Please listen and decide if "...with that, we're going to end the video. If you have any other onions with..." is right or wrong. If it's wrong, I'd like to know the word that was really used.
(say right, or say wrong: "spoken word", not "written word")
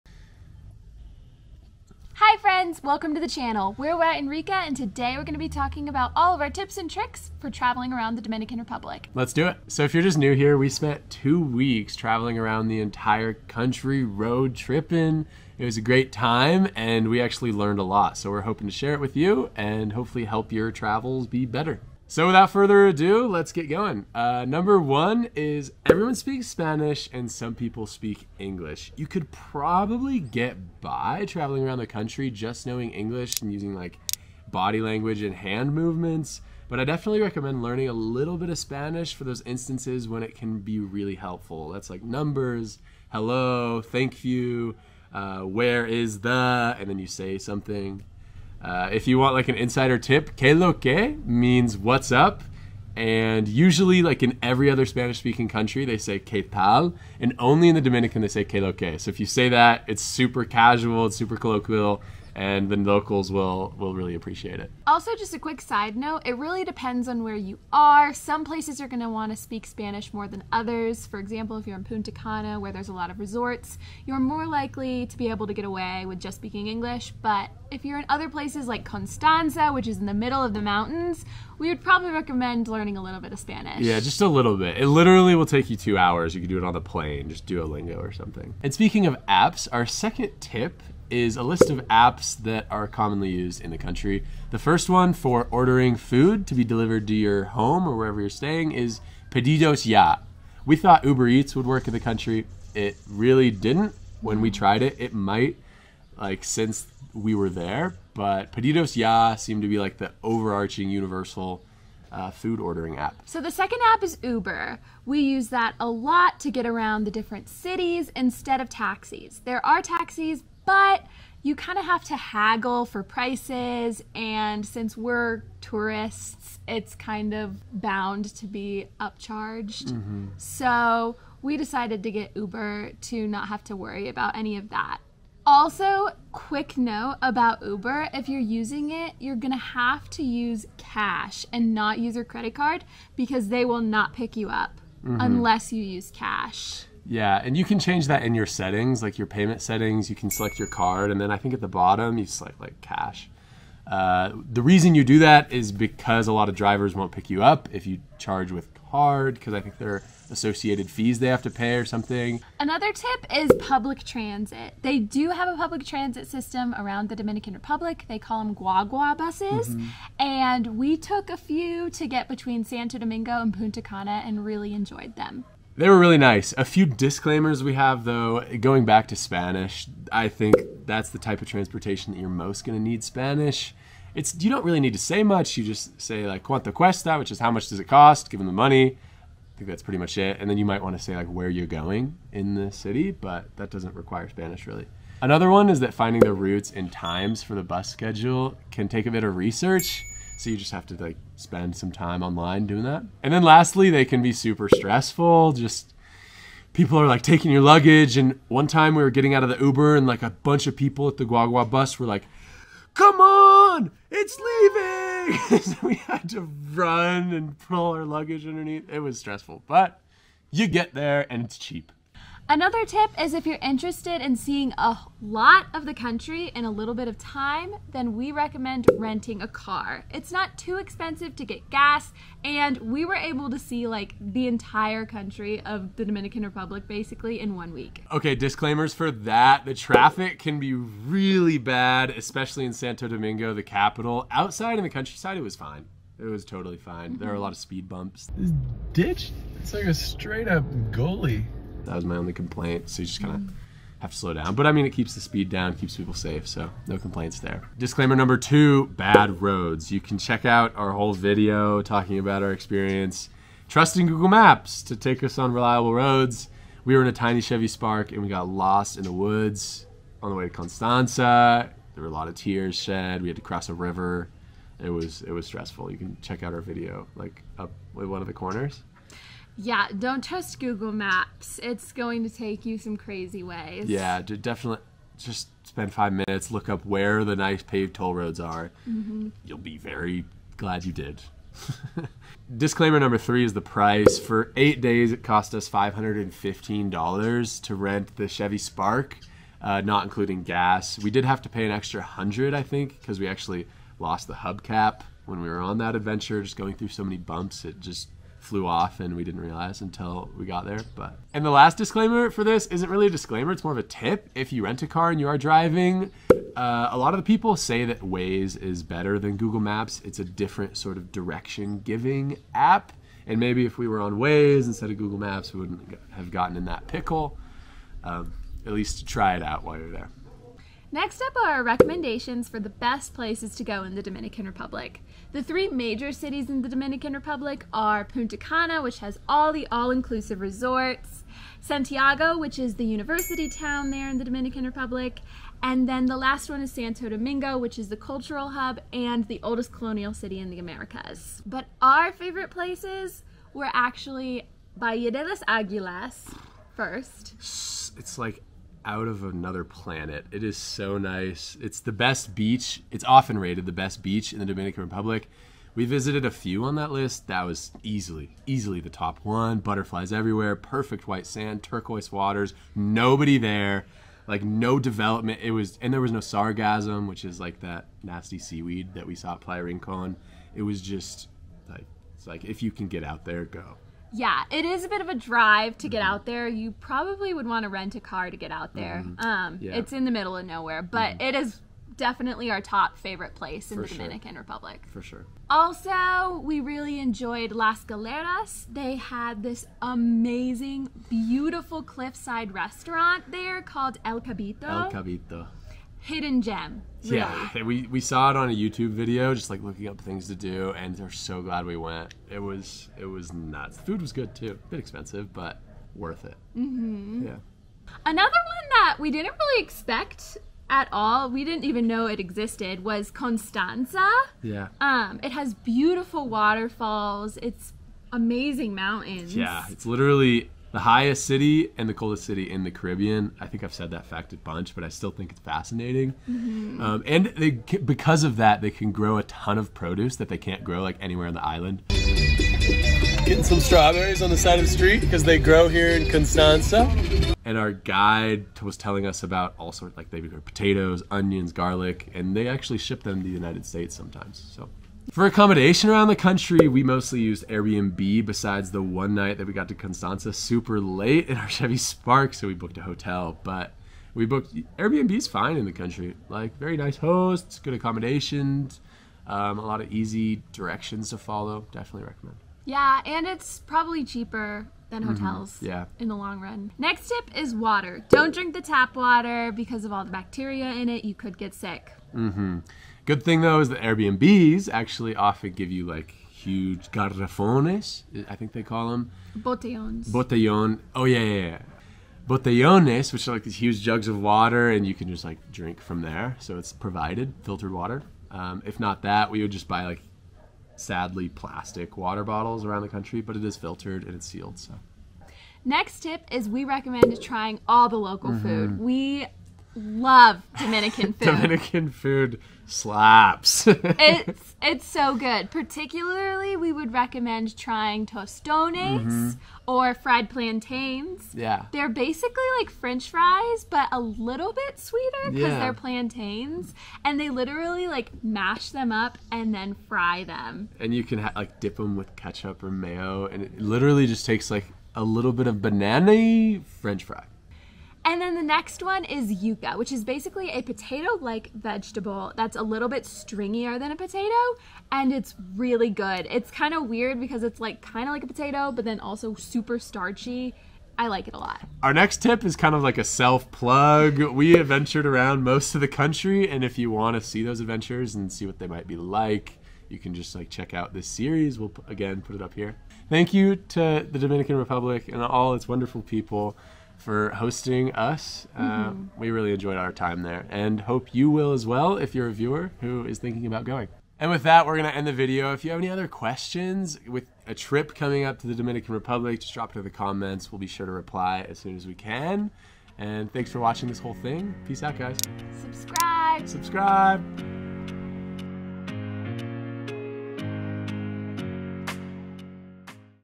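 wrong: "questions", not "onions".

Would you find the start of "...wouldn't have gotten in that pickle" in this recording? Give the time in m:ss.
5:25.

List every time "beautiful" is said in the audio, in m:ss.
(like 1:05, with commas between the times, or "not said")
6:41, 7:05.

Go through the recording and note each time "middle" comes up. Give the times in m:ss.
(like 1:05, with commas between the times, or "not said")
1:20, 6:30.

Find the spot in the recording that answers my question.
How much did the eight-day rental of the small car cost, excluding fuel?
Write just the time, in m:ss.
4:55.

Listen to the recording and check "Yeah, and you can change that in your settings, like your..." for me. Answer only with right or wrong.
right.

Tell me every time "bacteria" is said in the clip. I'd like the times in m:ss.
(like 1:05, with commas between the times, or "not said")
8:00.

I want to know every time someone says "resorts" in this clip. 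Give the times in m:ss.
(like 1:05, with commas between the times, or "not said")
1:13, 5:40.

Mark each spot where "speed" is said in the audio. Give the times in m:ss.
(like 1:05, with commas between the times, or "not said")
4:07, 4:15.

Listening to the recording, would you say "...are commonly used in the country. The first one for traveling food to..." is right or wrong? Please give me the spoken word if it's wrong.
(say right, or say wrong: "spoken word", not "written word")
wrong: "ordering", not "traveling".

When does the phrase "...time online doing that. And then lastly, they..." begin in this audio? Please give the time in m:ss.
3:21.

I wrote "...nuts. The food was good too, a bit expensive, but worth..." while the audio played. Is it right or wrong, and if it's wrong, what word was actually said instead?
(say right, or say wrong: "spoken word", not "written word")
right.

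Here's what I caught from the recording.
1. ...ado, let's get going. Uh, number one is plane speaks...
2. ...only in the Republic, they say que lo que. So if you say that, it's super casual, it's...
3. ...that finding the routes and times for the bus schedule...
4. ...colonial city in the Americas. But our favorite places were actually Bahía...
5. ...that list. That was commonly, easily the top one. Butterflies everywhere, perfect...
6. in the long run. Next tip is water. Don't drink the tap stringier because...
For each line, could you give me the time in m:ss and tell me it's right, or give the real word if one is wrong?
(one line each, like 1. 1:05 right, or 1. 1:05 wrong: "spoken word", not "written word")
1. 0:22 wrong: "everyone", not "plane"
2. 0:57 wrong: "Dominican", not "Republic"
3. 3:15 right
4. 5:49 right
5. 6:06 wrong: "easily", not "commonly"
6. 7:55 wrong: "water", not "stringier".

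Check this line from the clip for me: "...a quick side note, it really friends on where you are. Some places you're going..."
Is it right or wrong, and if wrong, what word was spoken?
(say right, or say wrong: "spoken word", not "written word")
wrong: "depends", not "friends".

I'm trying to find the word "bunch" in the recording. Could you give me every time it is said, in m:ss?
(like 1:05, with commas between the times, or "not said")
3:30, 7:14.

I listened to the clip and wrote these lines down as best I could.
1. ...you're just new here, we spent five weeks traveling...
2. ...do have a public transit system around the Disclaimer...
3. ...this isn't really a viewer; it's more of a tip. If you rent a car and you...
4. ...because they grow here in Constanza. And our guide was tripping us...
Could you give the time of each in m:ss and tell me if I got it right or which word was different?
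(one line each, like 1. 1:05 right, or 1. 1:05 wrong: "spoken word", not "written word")
1. 0:09 wrong: "two", not "five"
2. 2:44 wrong: "Dominican", not "Disclaimer"
3. 5:12 wrong: "disclaimer", not "viewer"
4. 7:25 wrong: "telling", not "tripping".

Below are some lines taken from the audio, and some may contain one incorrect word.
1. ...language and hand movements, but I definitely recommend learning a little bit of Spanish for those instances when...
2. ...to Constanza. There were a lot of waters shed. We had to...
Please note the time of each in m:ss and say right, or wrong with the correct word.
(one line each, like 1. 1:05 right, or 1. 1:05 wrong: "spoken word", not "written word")
1. 0:34 right
2. 4:30 wrong: "tears", not "waters".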